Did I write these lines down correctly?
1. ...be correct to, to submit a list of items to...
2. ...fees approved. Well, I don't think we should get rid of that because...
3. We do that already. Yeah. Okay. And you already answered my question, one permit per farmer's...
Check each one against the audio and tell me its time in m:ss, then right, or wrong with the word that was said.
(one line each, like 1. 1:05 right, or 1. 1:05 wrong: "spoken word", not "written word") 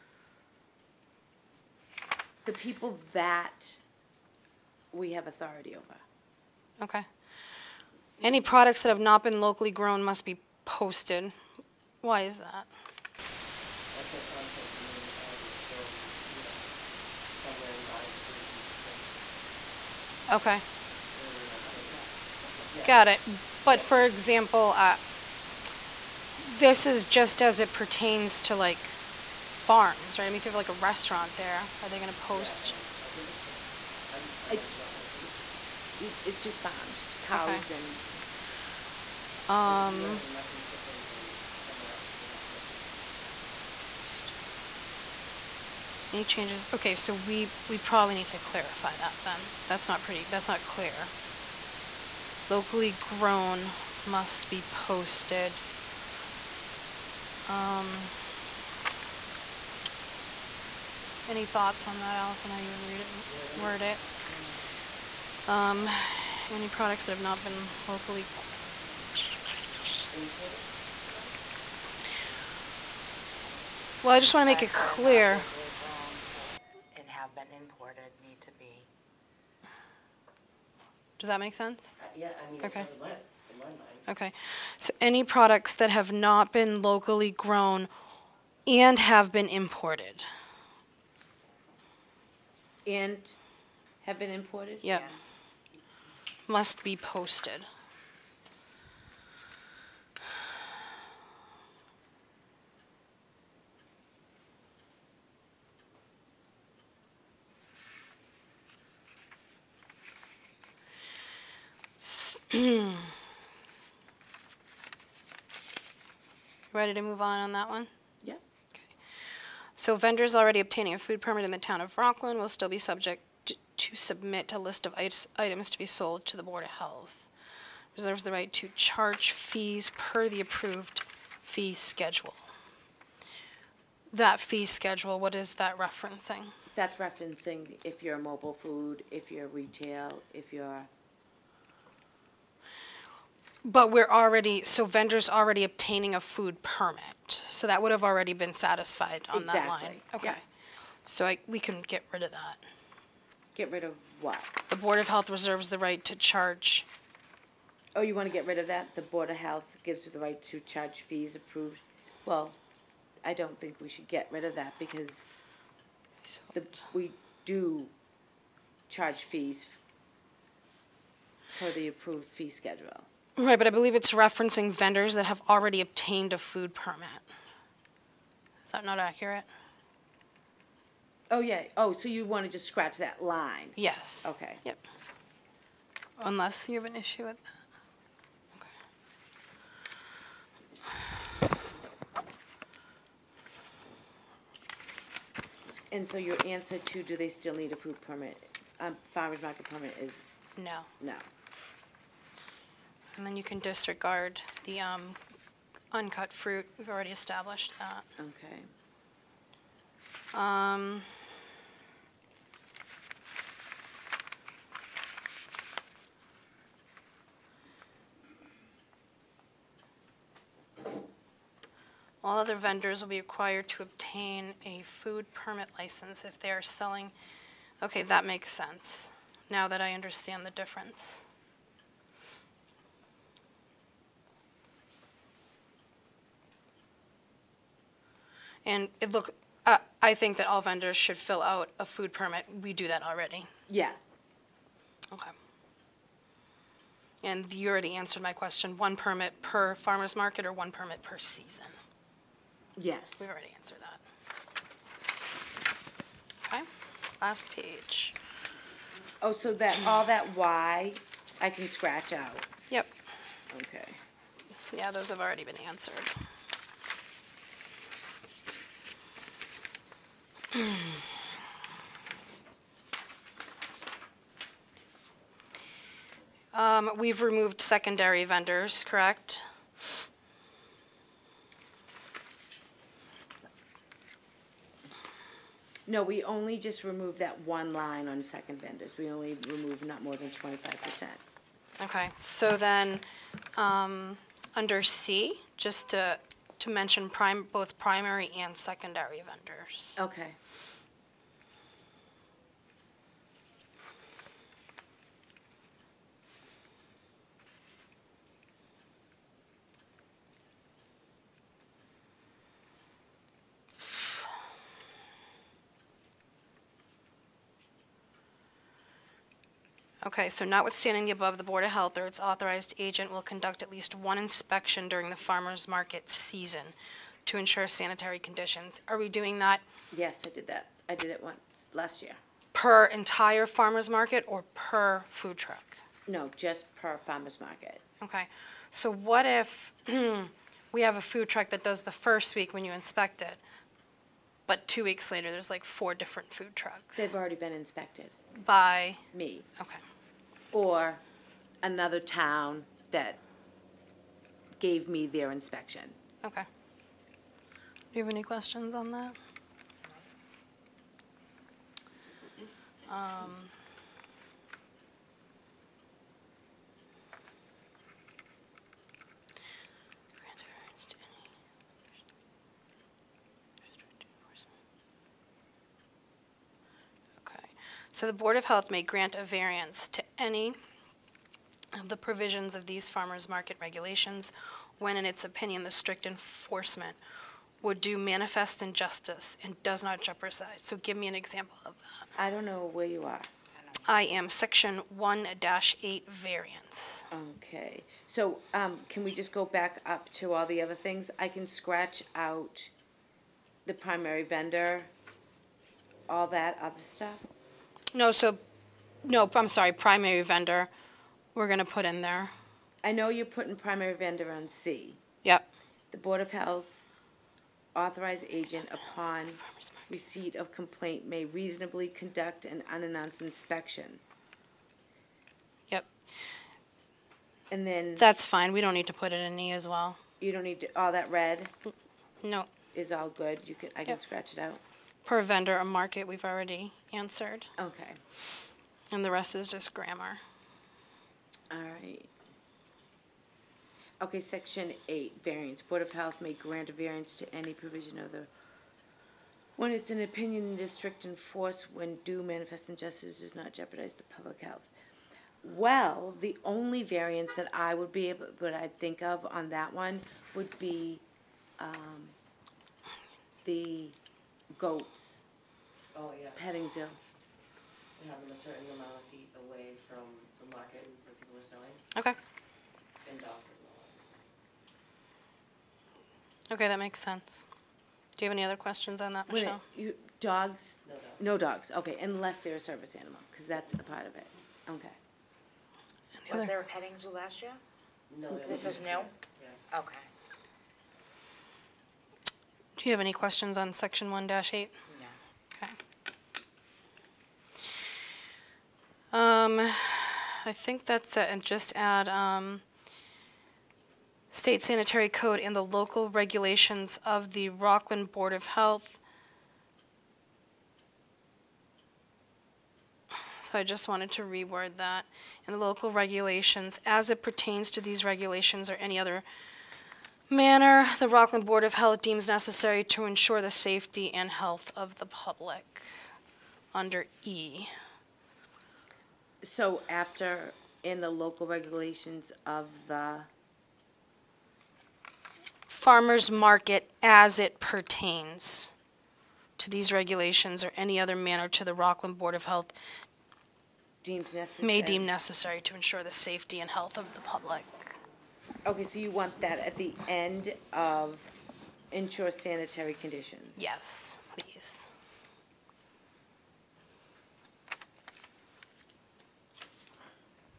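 1. 2:02 wrong: "subject", not "correct"
2. 2:41 right
3. 4:02 right.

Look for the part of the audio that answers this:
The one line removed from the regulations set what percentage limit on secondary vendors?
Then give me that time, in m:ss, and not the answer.
4:50.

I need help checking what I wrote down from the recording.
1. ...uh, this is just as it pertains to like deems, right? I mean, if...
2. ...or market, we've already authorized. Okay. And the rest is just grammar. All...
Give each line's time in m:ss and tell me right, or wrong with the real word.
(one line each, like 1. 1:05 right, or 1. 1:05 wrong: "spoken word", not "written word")
1. 0:24 wrong: "farms", not "deems"
2. 7:15 wrong: "answered", not "authorized".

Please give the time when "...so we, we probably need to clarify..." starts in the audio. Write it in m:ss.
0:46.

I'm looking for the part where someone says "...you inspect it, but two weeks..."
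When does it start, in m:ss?
5:42.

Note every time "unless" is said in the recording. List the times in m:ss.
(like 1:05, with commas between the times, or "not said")
3:06, 8:02.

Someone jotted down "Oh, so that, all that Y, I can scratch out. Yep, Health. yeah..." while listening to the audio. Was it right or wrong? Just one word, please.
wrong.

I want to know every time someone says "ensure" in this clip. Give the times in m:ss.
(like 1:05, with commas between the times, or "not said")
5:27, 8:43, 9:05, 9:11.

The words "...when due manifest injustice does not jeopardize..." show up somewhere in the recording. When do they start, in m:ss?
7:31.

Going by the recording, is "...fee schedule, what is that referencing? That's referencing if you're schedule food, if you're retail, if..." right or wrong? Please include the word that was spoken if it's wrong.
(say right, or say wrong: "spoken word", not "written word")
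wrong: "mobile", not "schedule".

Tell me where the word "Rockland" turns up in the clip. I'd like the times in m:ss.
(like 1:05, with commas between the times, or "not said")
2:01, 8:27, 8:41, 9:01.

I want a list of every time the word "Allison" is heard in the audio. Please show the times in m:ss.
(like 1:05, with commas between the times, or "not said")
1:02.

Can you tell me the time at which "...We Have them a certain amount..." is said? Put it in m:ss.
7:46.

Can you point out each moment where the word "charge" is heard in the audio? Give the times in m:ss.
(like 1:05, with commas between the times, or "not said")
2:08, 2:36, 2:40, 2:48.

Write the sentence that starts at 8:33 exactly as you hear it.
So I just wanted to reword that.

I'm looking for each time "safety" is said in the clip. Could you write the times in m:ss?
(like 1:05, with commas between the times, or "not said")
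8:43, 9:06.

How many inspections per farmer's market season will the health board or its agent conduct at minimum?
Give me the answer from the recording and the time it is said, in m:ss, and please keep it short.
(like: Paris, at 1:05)
at least one, at 5:23.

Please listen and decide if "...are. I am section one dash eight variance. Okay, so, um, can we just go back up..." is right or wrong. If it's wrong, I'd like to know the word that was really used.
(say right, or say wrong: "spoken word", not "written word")
right.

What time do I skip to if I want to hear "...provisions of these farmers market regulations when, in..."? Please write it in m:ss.
6:21.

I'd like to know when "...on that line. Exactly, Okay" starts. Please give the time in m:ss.
2:29.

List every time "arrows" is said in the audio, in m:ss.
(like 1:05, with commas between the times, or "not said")
not said.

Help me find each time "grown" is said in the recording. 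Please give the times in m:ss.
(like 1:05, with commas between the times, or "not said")
0:09, 0:52, 1:27.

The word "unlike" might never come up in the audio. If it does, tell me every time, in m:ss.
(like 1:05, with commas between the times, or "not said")
not said.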